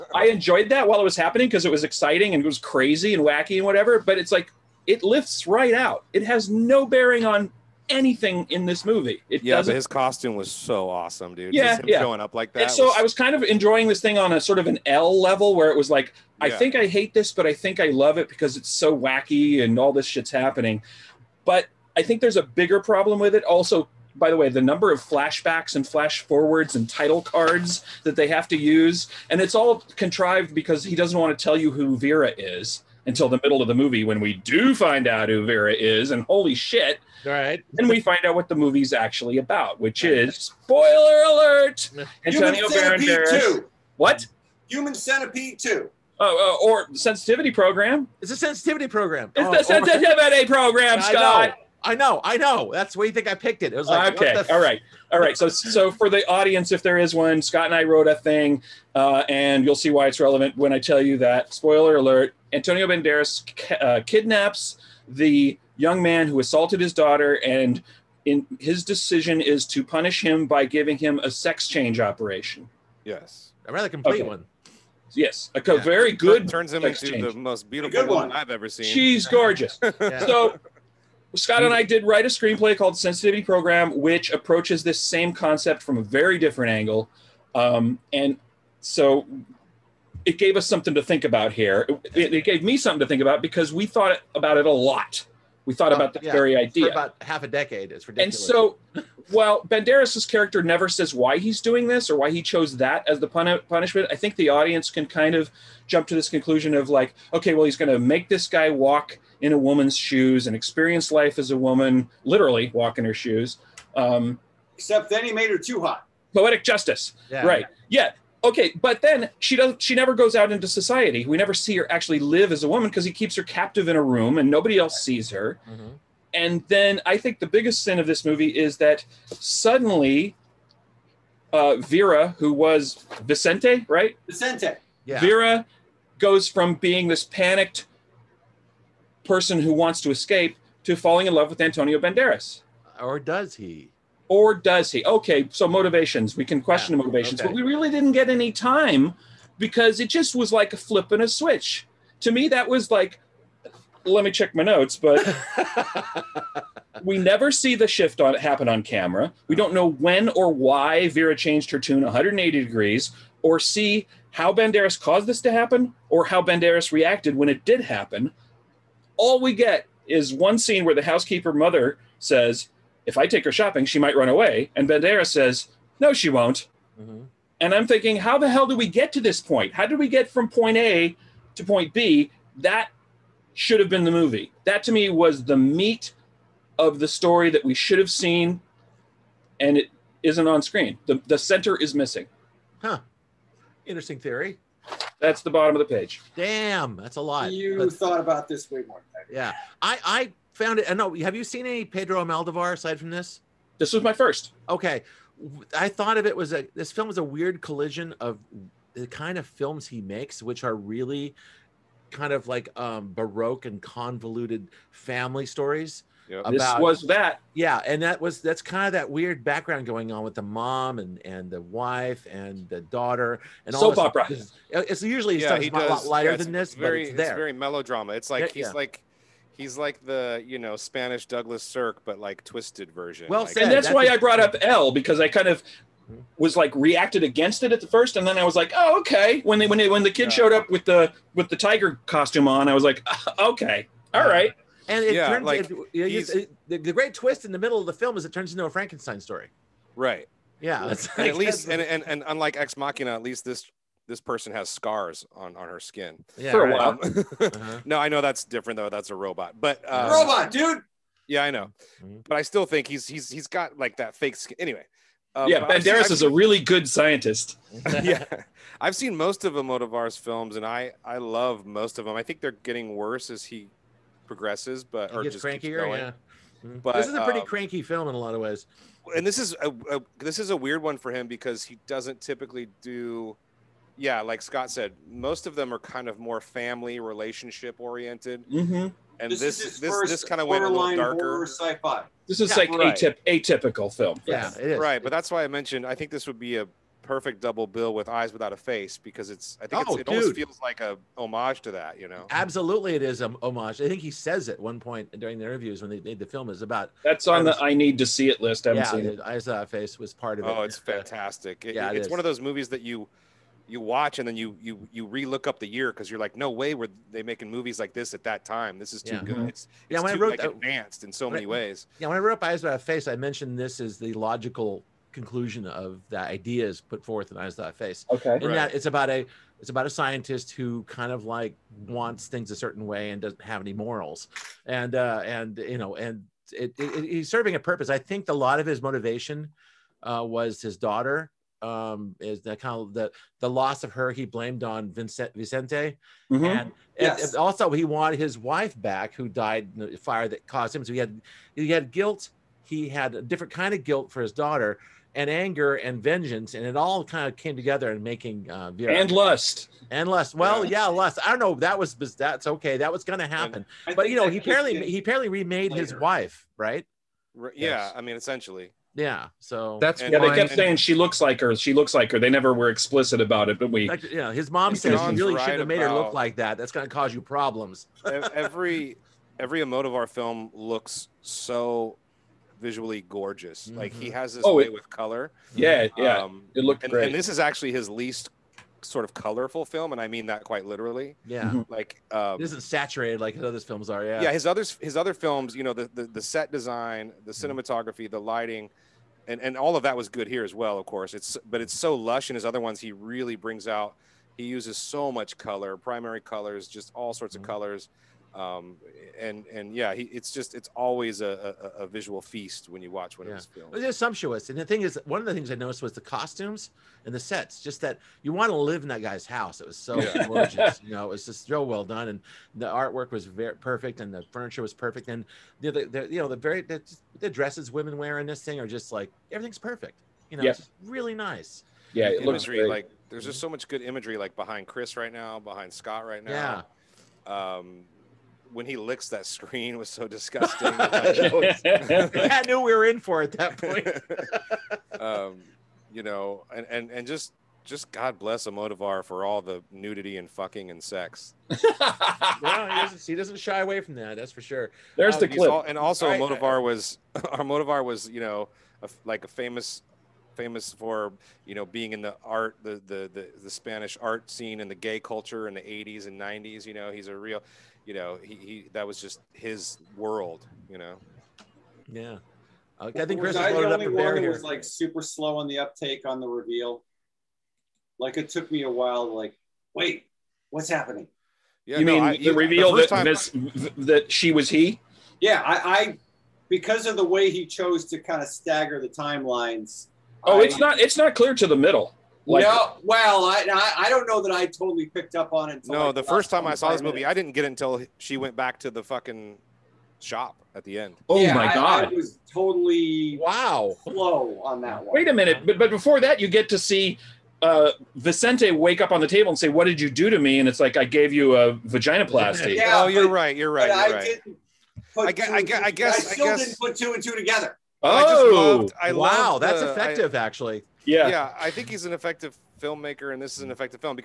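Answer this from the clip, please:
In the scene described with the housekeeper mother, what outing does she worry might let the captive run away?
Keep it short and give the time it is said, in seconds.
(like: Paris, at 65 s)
Shopping, at 173 s.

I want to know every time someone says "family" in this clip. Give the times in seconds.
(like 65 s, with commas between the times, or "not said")
214 s, 286 s.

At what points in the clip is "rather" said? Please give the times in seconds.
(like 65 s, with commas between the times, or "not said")
73 s.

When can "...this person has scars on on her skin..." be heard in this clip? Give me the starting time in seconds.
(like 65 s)
254 s.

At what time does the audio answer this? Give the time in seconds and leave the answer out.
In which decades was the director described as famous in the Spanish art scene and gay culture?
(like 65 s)
465 s.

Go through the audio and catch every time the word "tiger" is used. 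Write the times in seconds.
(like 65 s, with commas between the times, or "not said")
241 s.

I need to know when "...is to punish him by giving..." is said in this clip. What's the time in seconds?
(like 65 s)
69 s.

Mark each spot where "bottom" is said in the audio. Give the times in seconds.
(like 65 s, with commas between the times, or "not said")
195 s.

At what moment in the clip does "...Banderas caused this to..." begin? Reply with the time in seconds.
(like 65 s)
164 s.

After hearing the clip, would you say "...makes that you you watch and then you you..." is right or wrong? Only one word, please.
wrong.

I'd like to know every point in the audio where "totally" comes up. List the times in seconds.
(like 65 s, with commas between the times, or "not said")
494 s, 502 s.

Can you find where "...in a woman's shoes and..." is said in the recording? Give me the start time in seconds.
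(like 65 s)
109 s.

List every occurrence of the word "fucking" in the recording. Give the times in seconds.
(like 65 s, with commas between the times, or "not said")
450 s, 498 s.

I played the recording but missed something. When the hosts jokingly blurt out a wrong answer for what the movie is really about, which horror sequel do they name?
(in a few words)
Human Centipede Two.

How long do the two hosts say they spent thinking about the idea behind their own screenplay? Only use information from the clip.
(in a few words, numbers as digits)
Half a decade.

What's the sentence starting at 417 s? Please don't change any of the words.
Just that you want to live in that guy's house.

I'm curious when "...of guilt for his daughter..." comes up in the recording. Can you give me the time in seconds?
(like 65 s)
353 s.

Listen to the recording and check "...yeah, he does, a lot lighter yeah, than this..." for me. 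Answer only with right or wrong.
right.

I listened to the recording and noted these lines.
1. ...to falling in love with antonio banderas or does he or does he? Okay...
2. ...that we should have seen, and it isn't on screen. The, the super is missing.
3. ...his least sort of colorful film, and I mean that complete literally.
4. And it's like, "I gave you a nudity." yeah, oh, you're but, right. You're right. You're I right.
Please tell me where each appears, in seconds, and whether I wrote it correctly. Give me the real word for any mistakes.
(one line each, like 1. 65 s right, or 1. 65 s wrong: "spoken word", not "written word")
1. 140 s right
2. 187 s wrong: "center", not "super"
3. 387 s wrong: "quite", not "complete"
4. 510 s wrong: "vaginoplasty", not "nudity".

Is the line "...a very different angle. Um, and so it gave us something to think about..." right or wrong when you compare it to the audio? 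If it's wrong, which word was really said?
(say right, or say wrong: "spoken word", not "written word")
right.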